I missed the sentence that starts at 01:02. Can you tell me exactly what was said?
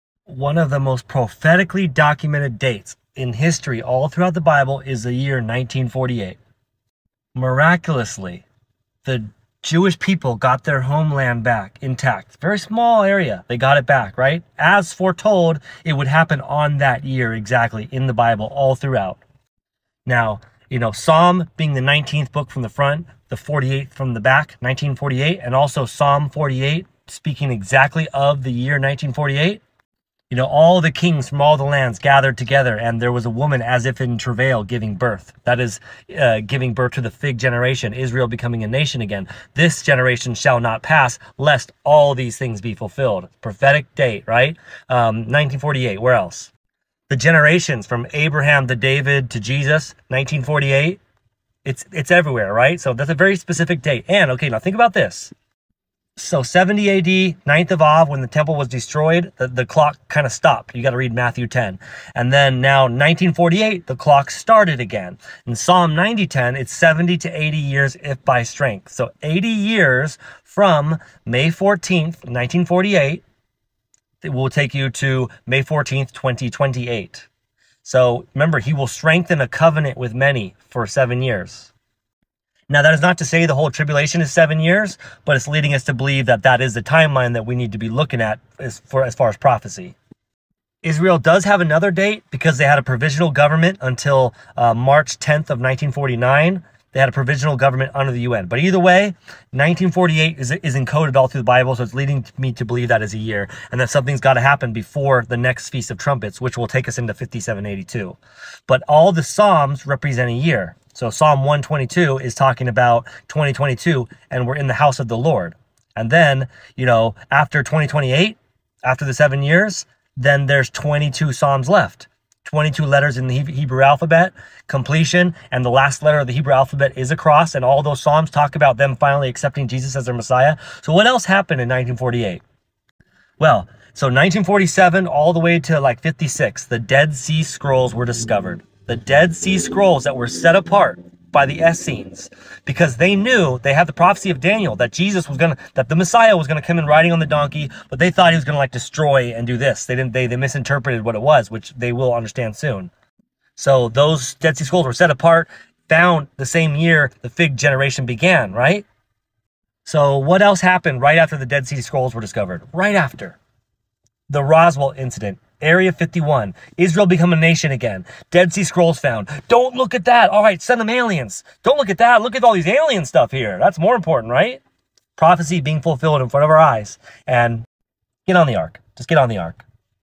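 And then now 1948, the clock started again.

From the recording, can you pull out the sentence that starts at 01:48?
But all the Psalms represent a year.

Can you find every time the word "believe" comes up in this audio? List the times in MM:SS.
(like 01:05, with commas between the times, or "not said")
01:25, 01:42.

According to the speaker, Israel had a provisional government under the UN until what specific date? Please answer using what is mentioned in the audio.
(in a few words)
March 10, 1949.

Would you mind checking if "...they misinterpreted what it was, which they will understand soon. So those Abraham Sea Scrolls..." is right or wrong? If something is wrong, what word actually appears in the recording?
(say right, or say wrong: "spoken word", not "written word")
wrong: "Dead", not "Abraham".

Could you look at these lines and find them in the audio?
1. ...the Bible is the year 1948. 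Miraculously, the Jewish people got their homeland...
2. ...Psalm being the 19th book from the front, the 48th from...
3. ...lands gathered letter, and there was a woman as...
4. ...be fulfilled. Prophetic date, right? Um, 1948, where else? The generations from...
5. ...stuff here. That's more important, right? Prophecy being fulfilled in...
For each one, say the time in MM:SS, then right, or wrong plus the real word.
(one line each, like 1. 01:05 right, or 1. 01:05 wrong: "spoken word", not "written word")
1. 00:04 right
2. 00:20 right
3. 00:31 wrong: "together", not "letter"
4. 00:42 right
5. 02:53 right.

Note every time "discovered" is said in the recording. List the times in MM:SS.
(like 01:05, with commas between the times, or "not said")
02:18, 02:42.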